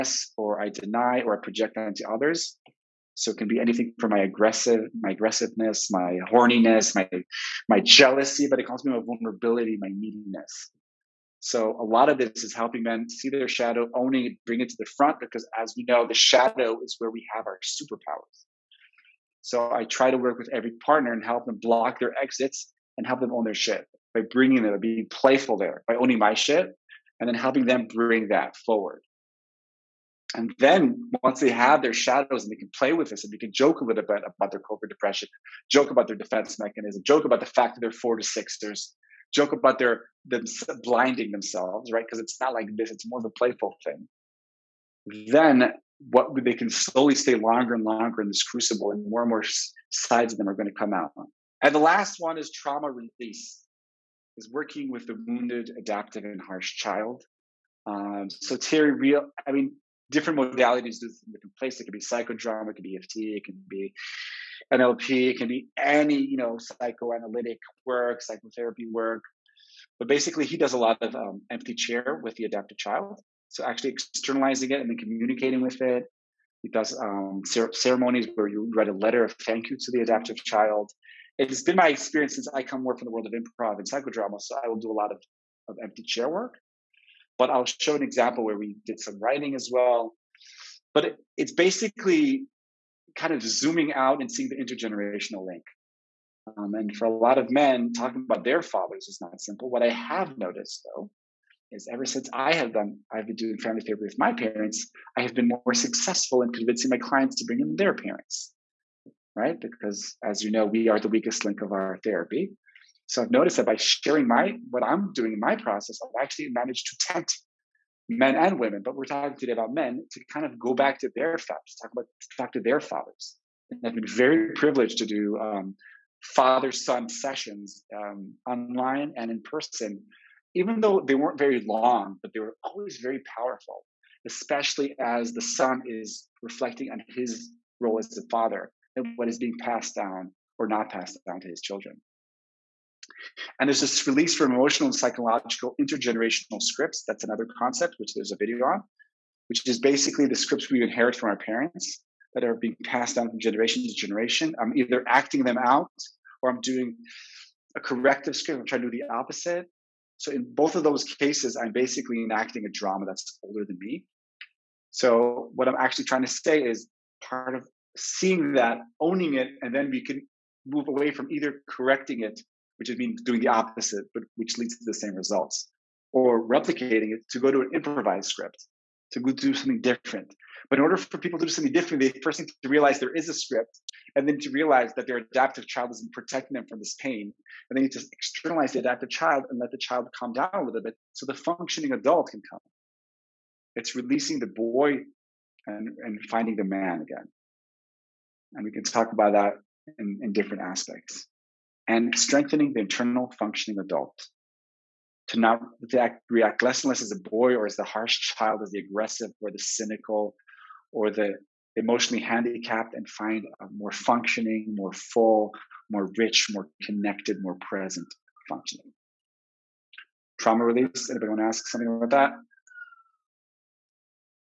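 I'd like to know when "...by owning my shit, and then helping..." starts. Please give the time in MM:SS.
00:25.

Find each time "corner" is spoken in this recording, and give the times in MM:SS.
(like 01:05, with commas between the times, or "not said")
not said.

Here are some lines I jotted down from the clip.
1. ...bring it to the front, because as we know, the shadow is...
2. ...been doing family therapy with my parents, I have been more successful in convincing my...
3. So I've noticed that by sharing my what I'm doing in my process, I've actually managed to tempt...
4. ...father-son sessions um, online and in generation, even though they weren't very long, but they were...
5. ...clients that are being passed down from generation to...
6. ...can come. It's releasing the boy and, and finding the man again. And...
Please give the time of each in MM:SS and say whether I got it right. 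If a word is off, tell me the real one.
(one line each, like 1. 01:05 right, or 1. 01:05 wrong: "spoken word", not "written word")
1. 00:14 right
2. 01:43 right
3. 01:53 right
4. 02:06 wrong: "person", not "generation"
5. 02:31 wrong: "parents", not "clients"
6. 03:12 right.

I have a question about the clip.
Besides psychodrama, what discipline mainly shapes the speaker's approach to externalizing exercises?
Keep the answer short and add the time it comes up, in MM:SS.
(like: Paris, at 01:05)
improv, at 01:23.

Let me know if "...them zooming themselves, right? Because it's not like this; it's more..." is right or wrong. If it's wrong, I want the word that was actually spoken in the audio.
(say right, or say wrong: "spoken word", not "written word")
wrong: "blinding", not "zooming".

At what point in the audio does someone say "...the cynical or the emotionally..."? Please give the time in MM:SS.
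03:29.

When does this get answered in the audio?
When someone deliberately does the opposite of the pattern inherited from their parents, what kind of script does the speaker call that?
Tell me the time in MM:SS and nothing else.
02:37.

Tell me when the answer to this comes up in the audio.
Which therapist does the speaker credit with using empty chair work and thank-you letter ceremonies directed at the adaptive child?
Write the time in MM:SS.
00:58.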